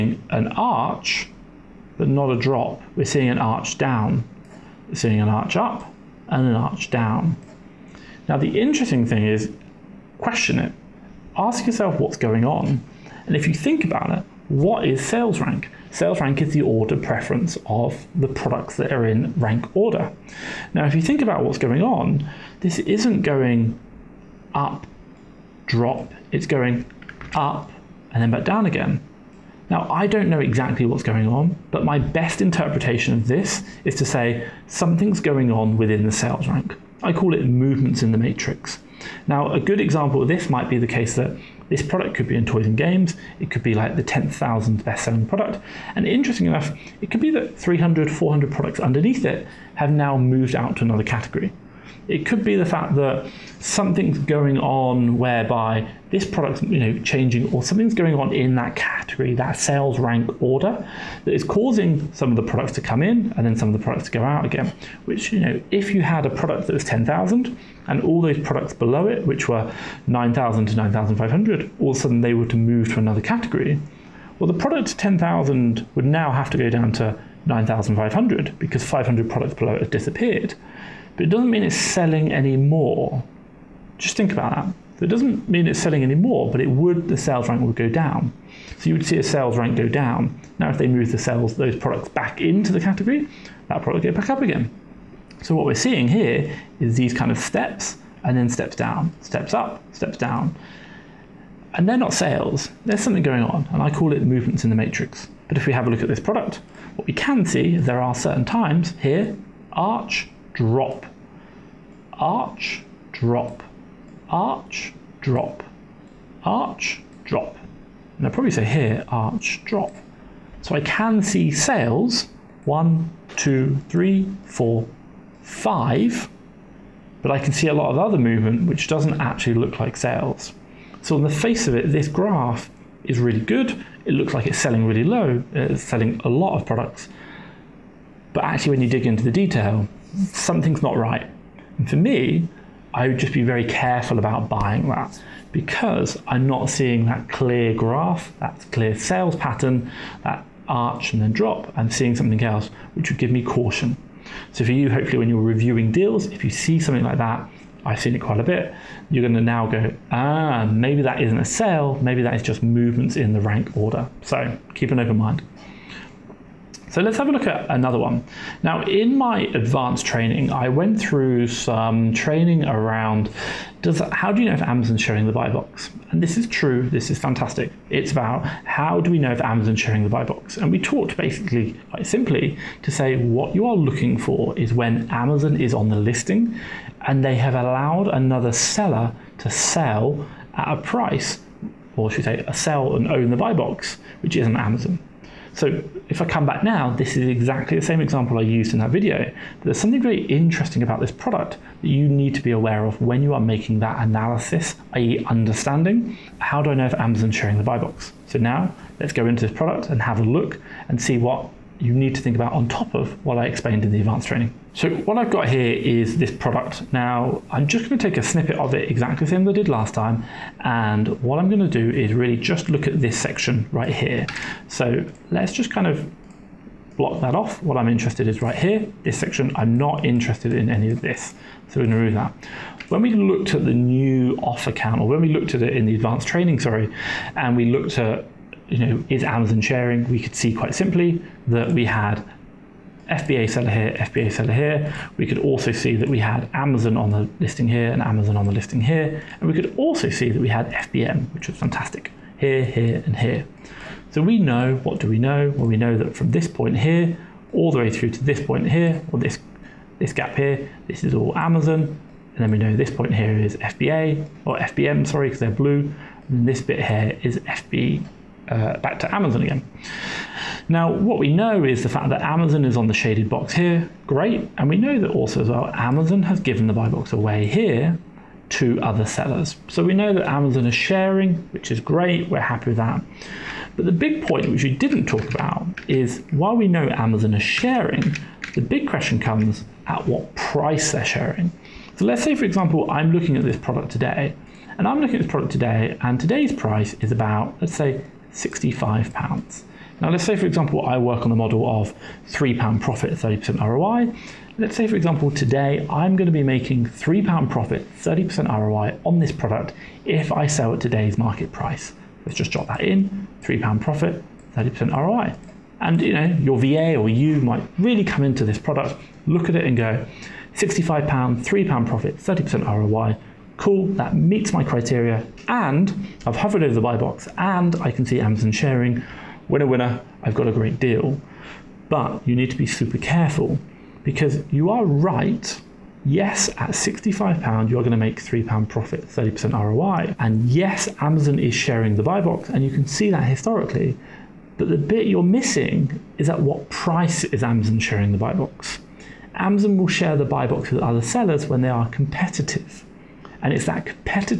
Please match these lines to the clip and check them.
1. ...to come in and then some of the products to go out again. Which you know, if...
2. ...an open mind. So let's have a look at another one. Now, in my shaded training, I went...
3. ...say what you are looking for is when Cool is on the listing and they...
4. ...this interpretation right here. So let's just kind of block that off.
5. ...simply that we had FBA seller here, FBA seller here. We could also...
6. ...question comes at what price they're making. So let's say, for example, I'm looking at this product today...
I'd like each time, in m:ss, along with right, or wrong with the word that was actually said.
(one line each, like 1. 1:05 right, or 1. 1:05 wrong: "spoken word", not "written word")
1. 1:02 right
2. 2:44 wrong: "advanced", not "shaded"
3. 3:02 wrong: "Amazon", not "Cool"
4. 3:42 wrong: "section", not "interpretation"
5. 4:00 right
6. 4:48 wrong: "sharing", not "making".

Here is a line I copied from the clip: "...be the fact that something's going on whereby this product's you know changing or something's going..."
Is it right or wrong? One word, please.
right.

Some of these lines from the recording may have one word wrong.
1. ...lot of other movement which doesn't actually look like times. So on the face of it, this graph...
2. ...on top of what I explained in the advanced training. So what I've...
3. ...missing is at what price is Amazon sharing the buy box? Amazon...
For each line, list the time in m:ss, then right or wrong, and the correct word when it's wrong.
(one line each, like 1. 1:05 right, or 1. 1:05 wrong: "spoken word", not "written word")
1. 2:07 wrong: "sales", not "times"
2. 3:32 right
3. 5:45 right.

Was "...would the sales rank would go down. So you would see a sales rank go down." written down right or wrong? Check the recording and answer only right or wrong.
right.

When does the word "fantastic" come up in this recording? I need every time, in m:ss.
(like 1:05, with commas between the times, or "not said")
2:57, 4:11.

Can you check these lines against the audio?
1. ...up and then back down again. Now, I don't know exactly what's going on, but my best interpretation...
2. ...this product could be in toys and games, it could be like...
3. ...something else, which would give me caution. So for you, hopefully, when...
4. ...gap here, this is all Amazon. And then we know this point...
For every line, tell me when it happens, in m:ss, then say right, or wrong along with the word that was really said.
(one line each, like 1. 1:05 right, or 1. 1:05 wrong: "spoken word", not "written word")
1. 0:27 right
2. 0:41 right
3. 2:32 right
4. 4:20 right.